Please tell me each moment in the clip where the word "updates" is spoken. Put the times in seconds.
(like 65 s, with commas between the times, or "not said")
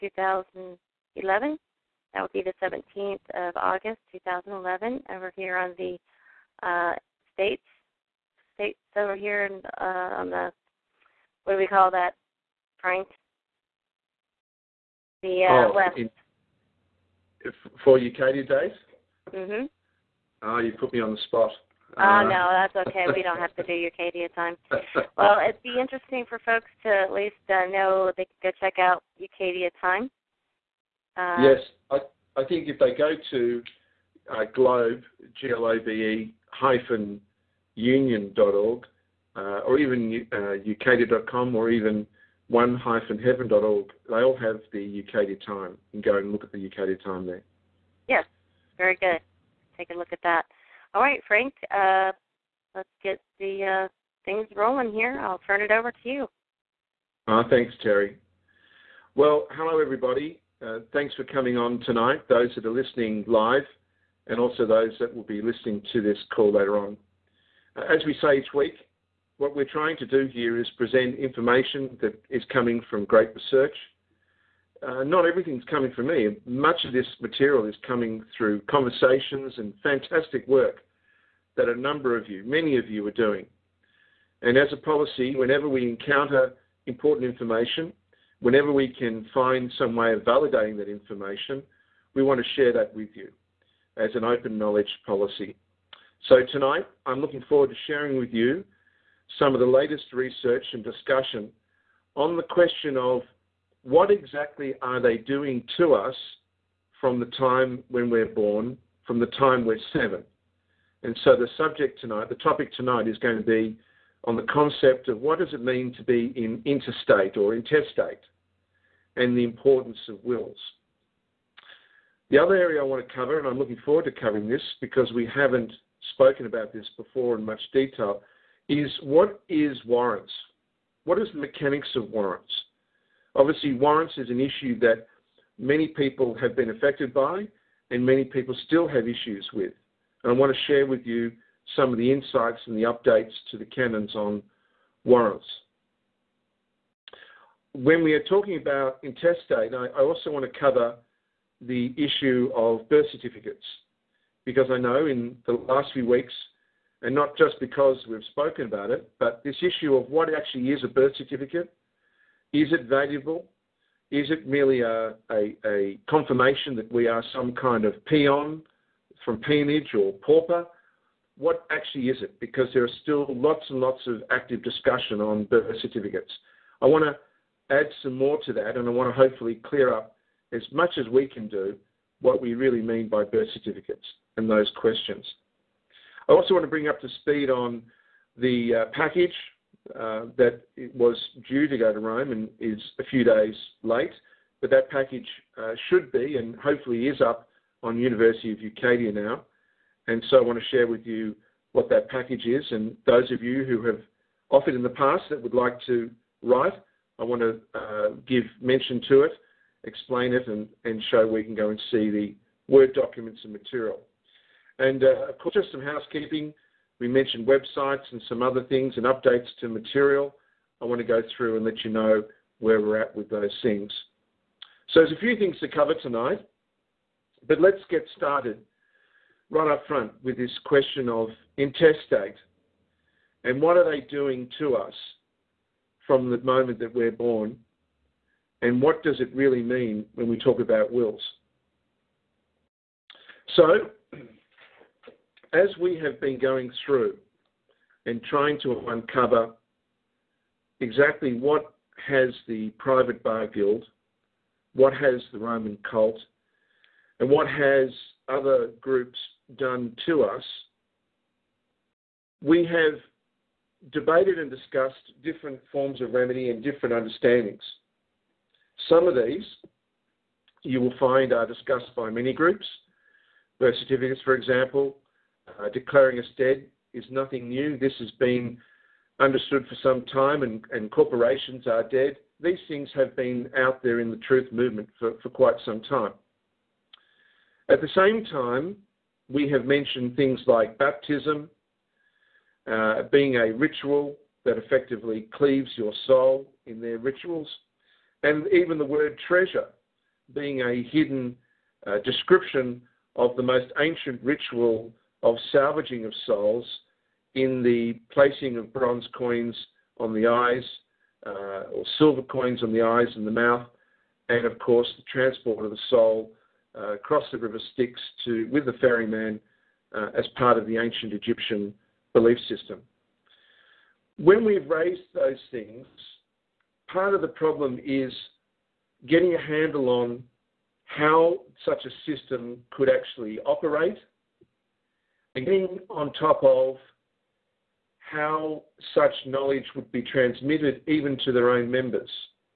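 142 s, 219 s.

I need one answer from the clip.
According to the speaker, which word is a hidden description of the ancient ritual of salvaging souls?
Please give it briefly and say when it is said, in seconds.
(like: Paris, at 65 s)
treasure, at 299 s.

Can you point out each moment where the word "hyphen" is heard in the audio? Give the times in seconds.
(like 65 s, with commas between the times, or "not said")
36 s, 42 s.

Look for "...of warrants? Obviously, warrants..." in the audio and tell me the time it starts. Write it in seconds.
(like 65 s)
131 s.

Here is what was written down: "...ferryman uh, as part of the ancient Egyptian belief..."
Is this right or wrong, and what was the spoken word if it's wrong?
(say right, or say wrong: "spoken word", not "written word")
right.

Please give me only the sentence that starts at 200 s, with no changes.
And so I want to share with you what that package is.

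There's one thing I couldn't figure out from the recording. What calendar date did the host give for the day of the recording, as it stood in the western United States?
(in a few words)
17 August 2011.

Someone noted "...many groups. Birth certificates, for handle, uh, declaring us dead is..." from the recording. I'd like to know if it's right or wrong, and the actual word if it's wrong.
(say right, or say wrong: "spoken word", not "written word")
wrong: "example", not "handle".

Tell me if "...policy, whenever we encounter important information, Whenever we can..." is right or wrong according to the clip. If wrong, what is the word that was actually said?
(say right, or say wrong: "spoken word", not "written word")
right.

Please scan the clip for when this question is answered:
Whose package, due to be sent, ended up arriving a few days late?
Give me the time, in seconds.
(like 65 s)
191 s.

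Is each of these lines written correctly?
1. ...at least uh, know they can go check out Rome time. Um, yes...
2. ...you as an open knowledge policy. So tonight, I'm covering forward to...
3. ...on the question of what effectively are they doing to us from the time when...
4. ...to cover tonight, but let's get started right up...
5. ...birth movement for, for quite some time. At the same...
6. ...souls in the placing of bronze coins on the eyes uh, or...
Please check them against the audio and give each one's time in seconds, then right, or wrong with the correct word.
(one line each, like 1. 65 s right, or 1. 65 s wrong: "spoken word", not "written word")
1. 26 s wrong: "Ucadia", not "Rome"
2. 93 s wrong: "looking", not "covering"
3. 102 s wrong: "exactly", not "effectively"
4. 225 s right
5. 284 s wrong: "truth", not "birth"
6. 306 s right.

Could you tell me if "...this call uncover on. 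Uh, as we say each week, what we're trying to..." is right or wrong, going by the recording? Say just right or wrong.
wrong.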